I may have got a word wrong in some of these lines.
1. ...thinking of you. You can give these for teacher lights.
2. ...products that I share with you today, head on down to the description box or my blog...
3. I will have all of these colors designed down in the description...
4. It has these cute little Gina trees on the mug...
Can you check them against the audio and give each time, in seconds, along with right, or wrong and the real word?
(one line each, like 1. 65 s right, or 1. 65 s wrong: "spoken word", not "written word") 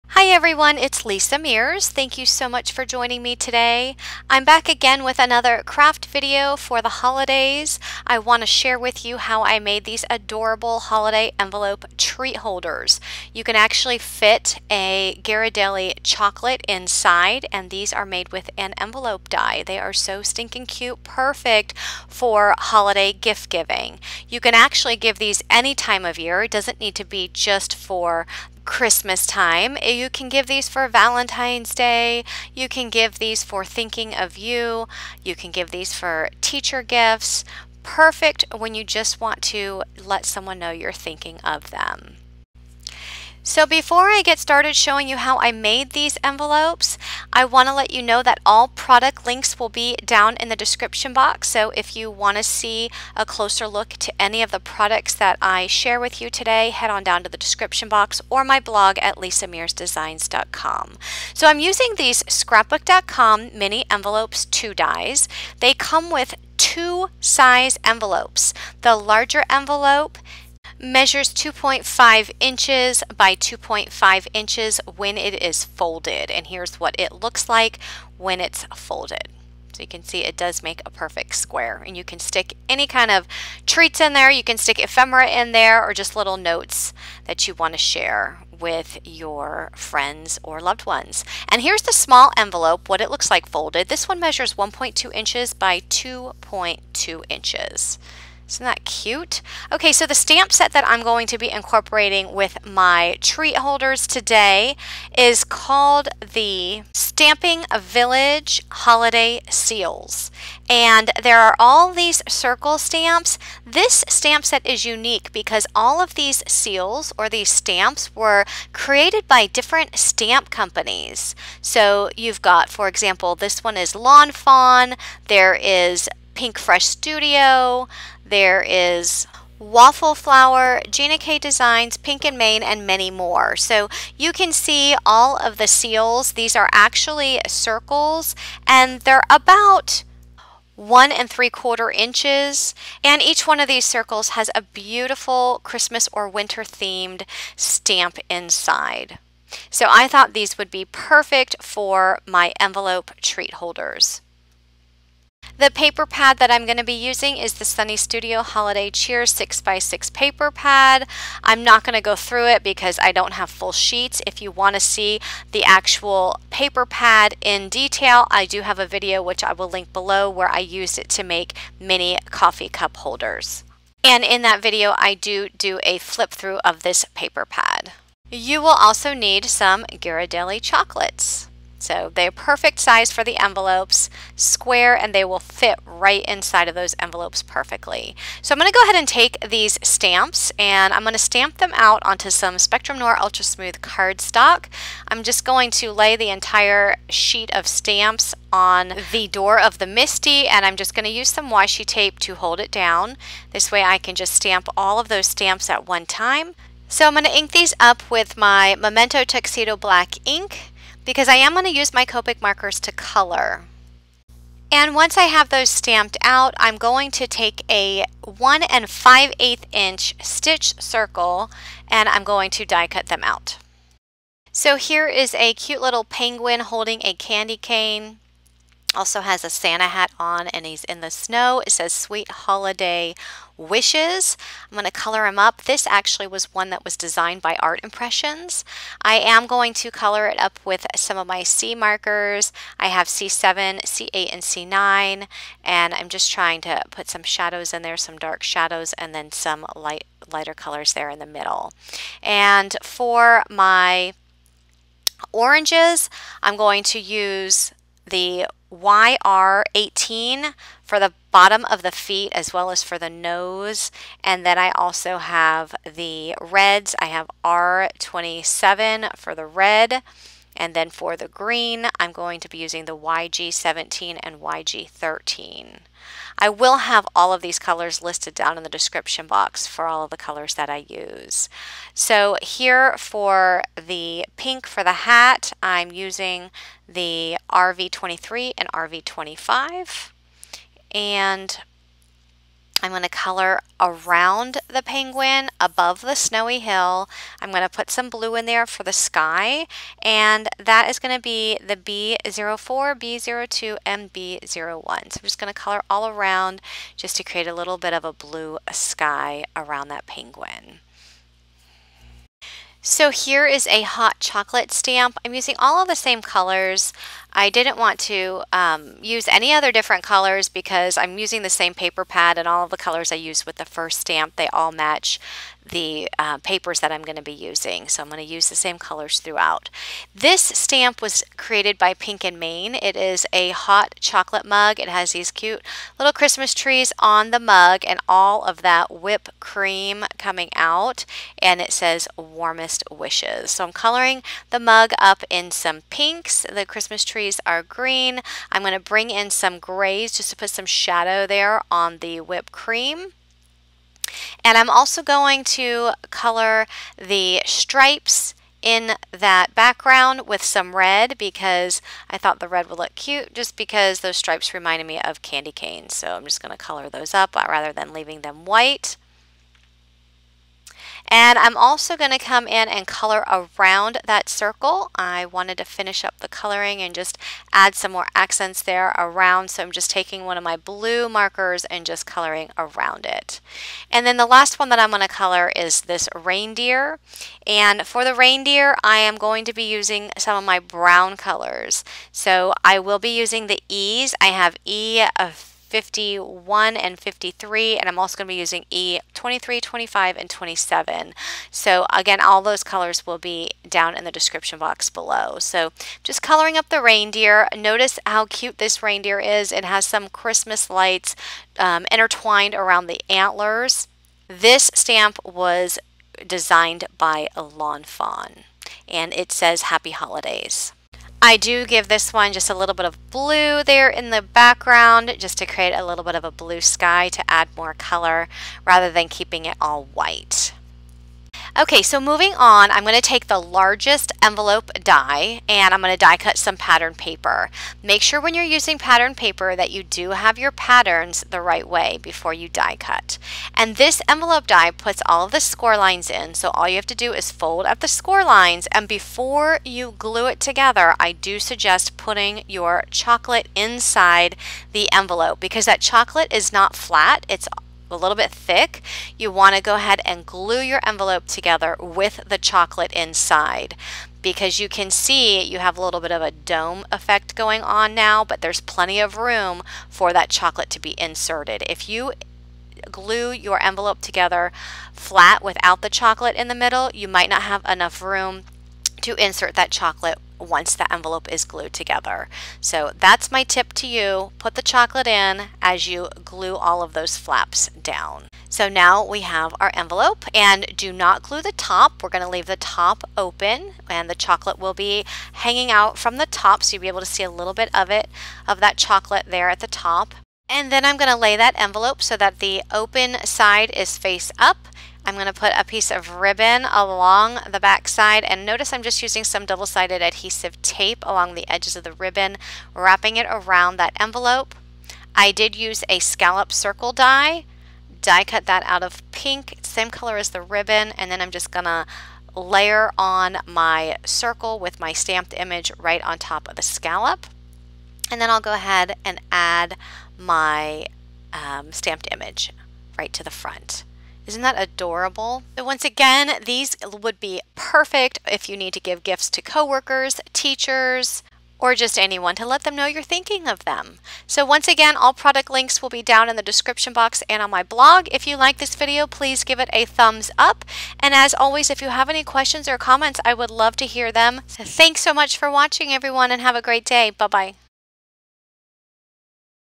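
1. 33 s wrong: "gifts", not "lights"
2. 54 s right
3. 276 s wrong: "listed", not "designed"
4. 334 s wrong: "Christmas", not "Gina".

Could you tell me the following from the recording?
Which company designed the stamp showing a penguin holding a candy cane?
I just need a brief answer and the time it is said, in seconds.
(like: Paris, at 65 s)
Art Impressions, at 237 s.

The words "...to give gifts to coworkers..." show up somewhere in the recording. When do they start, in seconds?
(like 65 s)
538 s.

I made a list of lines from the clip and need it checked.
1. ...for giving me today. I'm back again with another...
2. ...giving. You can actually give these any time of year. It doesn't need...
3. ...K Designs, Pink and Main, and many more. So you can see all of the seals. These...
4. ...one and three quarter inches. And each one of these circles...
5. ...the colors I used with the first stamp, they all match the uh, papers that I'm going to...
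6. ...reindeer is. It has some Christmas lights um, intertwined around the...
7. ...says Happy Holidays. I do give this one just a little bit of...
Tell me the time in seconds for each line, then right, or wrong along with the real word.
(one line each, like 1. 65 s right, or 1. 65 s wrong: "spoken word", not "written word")
1. 2 s wrong: "joining", not "giving"
2. 23 s right
3. 131 s right
4. 140 s right
5. 322 s right
6. 408 s right
7. 419 s right.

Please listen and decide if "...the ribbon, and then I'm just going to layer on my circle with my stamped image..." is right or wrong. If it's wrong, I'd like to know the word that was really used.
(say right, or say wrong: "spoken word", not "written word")
right.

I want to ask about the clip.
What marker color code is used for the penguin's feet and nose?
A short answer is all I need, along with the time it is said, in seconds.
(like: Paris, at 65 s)
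YR18, at 258 s.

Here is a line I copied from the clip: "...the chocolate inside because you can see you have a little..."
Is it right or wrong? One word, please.
right.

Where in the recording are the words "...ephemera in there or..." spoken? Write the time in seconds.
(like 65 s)
84 s.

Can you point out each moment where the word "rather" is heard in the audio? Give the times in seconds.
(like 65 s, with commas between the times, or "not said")
367 s, 428 s.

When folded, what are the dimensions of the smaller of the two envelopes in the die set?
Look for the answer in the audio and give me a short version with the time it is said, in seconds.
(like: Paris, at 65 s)
1.2 inches by 2.2 inches, at 94 s.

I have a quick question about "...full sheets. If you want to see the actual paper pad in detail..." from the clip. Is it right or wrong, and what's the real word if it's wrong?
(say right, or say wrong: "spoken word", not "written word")
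right.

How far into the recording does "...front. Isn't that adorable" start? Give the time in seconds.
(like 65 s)
533 s.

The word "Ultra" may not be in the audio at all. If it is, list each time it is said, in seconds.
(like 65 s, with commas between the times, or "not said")
193 s.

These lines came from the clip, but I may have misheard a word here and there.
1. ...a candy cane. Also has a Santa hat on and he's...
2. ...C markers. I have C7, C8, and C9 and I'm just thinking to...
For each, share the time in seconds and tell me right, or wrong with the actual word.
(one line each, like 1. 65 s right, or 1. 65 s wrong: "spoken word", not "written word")
1. 227 s right
2. 241 s wrong: "trying", not "thinking".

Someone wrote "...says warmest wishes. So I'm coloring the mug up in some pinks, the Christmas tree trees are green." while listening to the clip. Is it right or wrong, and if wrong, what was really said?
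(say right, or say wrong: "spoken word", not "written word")
right.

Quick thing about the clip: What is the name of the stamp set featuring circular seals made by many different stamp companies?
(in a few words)
Stamping Village Holiday Seals.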